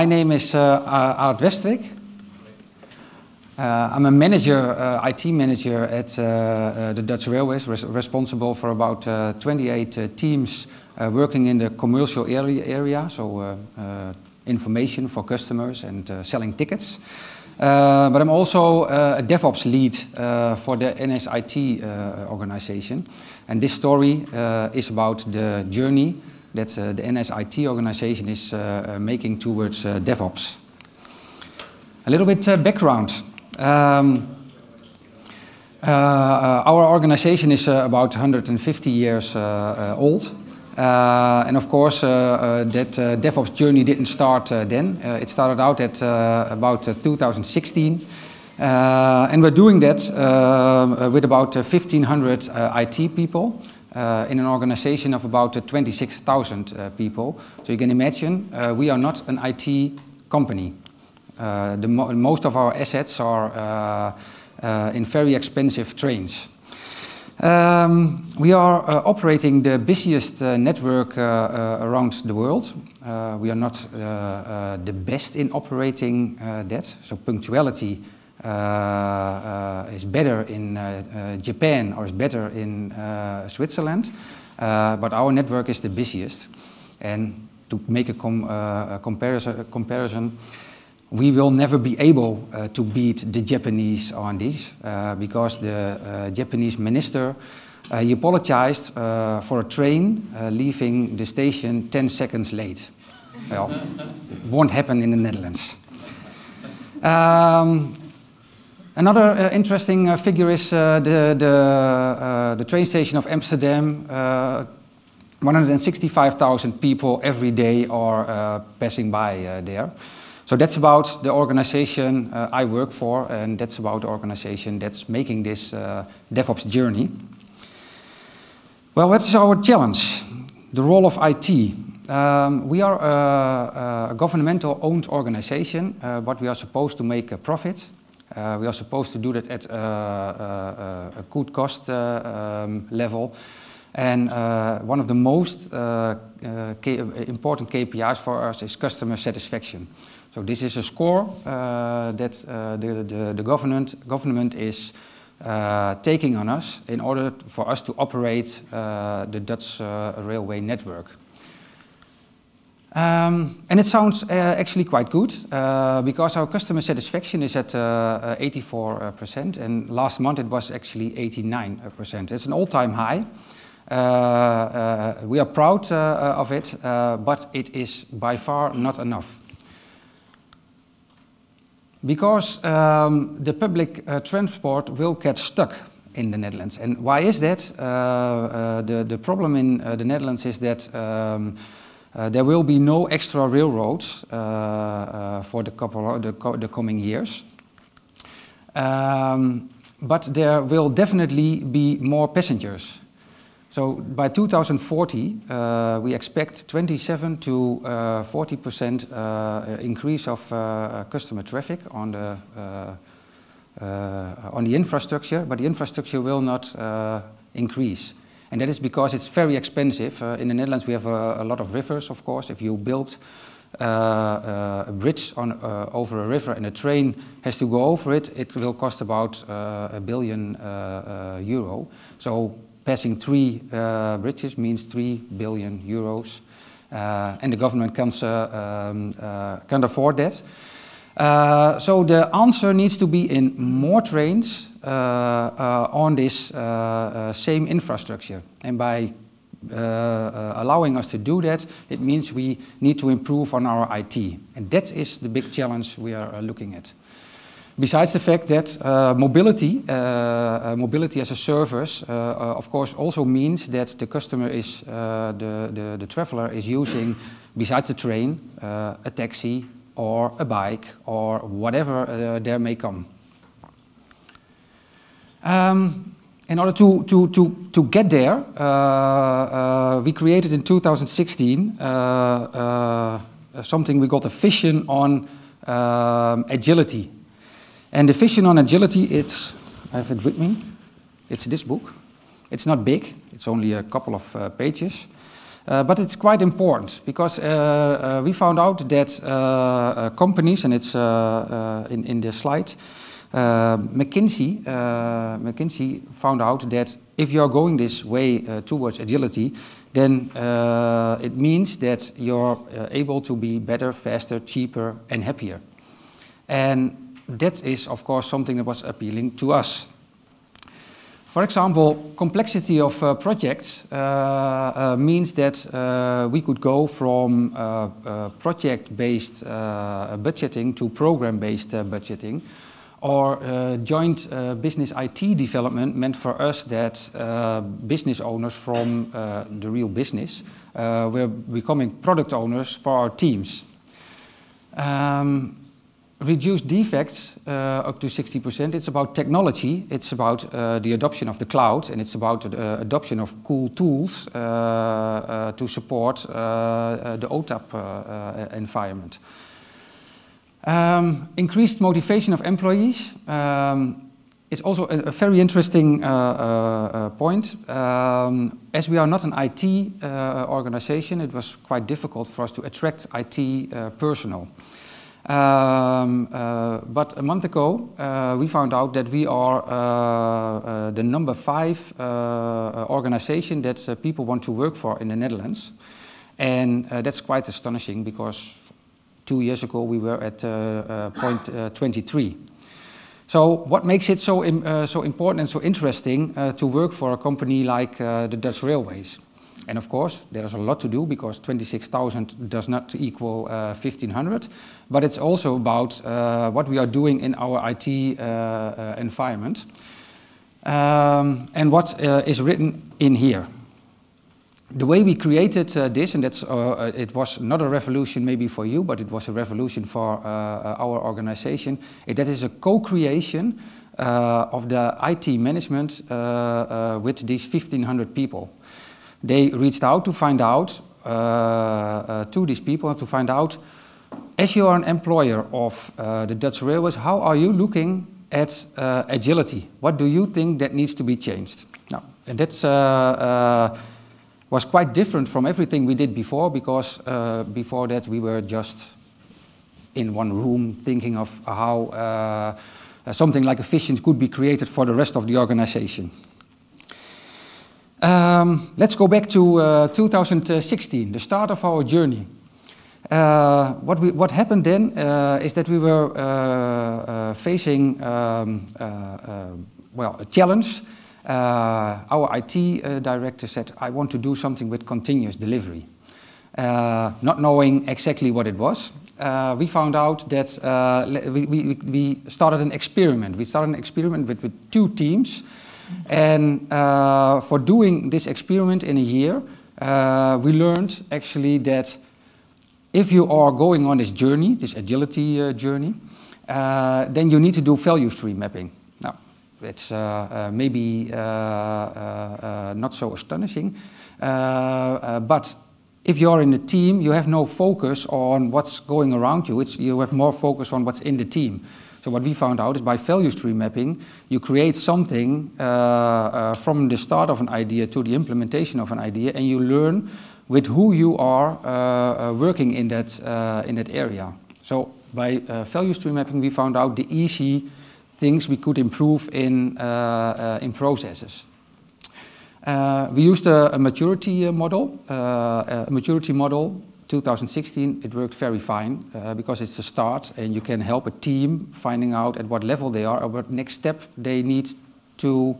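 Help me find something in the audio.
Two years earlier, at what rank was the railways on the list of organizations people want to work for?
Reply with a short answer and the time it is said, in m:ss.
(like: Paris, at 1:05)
23, at 6:31.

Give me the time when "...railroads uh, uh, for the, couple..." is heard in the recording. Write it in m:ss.
3:13.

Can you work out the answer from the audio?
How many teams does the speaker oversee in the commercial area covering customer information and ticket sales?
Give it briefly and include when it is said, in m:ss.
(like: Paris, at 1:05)
28, at 0:09.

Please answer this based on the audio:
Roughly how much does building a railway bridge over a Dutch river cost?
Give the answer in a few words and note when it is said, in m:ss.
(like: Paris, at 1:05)
a billion euro, at 3:49.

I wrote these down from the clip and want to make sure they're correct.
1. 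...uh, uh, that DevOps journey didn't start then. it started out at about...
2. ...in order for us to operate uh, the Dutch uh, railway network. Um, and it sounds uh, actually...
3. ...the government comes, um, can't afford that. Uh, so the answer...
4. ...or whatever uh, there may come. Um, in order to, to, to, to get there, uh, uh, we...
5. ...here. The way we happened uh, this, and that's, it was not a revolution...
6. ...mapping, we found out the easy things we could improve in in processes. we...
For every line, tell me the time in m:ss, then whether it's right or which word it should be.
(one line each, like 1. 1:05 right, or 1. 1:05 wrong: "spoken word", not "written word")
1. 0:42 right
2. 2:36 right
3. 3:57 right
4. 4:31 right
5. 6:53 wrong: "created", not "happened"
6. 8:46 right.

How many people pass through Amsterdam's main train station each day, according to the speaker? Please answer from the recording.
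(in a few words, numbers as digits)
165,000.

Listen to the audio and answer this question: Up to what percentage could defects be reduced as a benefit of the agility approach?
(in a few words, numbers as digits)
60%.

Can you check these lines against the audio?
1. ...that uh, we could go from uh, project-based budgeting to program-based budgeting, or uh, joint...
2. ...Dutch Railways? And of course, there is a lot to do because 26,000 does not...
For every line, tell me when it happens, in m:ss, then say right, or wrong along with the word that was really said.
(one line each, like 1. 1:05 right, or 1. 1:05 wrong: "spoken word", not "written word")
1. 5:25 right
2. 6:38 right.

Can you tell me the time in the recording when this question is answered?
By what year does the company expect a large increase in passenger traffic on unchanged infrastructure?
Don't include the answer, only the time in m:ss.
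3:24.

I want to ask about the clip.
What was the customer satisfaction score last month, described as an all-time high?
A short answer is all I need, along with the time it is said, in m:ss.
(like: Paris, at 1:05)
89%, at 2:51.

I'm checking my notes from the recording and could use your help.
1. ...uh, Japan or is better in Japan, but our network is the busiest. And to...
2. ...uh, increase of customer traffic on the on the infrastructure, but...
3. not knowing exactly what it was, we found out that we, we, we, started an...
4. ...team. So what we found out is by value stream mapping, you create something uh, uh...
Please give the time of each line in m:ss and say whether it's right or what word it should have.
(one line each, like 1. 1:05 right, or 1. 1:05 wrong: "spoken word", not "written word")
1. 1:21 wrong: "Switzerland", not "Japan"
2. 3:29 right
3. 7:56 right
4. 8:31 right.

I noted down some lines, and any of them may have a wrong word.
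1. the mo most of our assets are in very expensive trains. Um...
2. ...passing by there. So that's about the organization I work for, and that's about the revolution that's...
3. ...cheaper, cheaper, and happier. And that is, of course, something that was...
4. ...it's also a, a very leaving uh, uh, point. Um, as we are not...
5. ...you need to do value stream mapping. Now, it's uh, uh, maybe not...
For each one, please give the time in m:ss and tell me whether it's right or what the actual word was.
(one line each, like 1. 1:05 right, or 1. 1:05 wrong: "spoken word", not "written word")
1. 1:01 right
2. 1:58 wrong: "organization", not "revolution"
3. 5:13 wrong: "faster", not "cheaper"
4. 6:04 wrong: "interesting", not "leaving"
5. 8:17 right.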